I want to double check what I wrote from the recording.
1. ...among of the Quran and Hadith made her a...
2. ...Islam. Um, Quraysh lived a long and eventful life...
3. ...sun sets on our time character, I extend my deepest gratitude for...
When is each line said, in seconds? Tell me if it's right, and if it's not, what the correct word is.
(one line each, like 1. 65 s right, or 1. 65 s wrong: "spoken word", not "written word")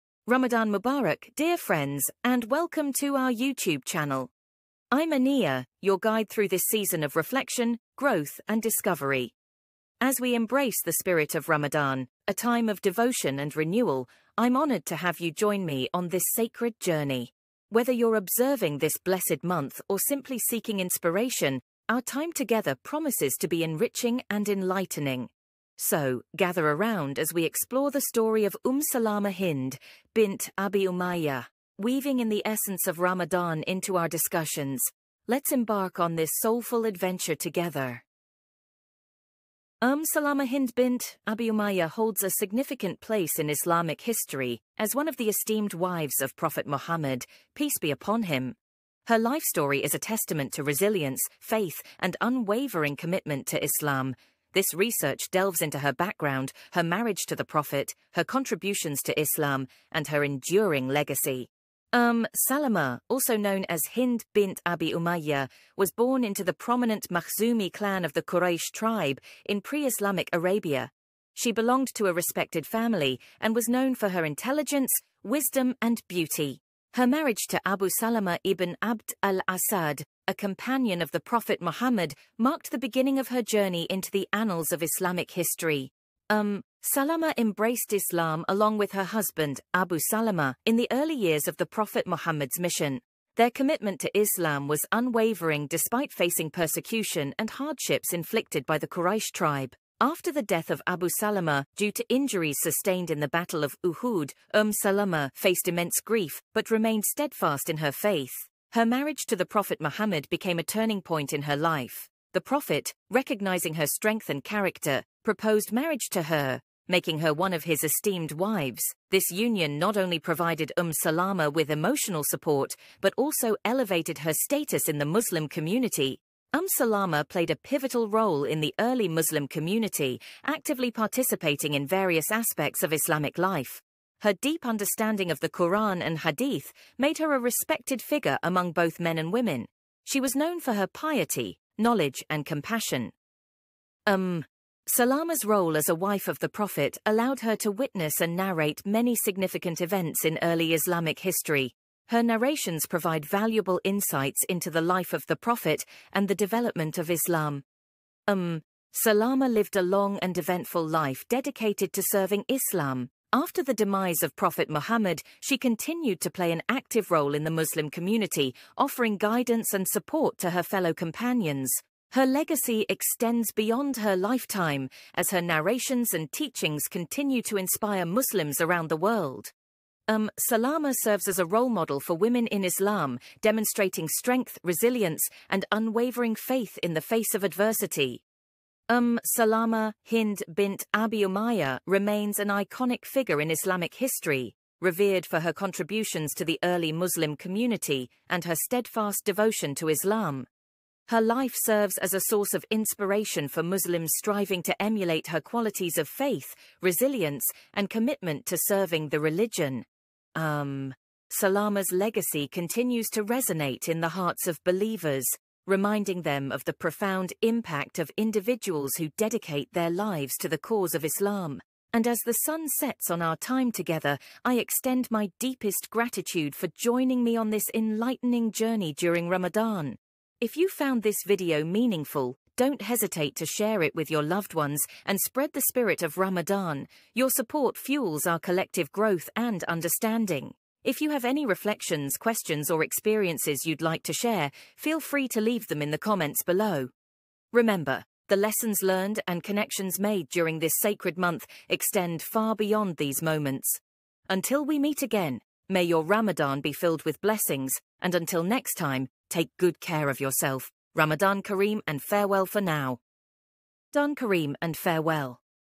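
1. 134 s wrong: "understanding", not "among"
2. 157 s wrong: "Salama", not "Quraysh"
3. 222 s wrong: "together", not "character".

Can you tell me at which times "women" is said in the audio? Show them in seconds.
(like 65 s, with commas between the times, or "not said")
139 s, 182 s.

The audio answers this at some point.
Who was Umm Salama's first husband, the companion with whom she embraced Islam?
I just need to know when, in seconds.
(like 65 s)
77 s.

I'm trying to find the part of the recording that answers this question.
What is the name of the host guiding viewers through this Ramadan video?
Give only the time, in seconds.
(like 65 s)
5 s.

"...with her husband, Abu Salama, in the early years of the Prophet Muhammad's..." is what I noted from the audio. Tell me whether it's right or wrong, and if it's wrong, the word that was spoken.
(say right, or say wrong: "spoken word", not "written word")
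right.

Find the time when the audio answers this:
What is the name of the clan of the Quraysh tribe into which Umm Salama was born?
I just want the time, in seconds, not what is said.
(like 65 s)
67 s.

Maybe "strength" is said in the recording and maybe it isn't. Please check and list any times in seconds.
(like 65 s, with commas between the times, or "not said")
113 s, 184 s.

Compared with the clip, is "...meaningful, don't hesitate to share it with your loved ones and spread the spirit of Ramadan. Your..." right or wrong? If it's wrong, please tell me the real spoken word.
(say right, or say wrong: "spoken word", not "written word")
right.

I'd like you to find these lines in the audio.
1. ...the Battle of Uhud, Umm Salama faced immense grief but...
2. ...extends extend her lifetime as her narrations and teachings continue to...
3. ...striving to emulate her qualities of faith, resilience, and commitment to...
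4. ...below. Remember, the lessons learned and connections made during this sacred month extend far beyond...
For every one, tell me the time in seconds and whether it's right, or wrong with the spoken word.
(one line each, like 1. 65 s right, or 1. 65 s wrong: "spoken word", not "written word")
1. 103 s right
2. 172 s wrong: "beyond", not "extend"
3. 204 s right
4. 246 s right.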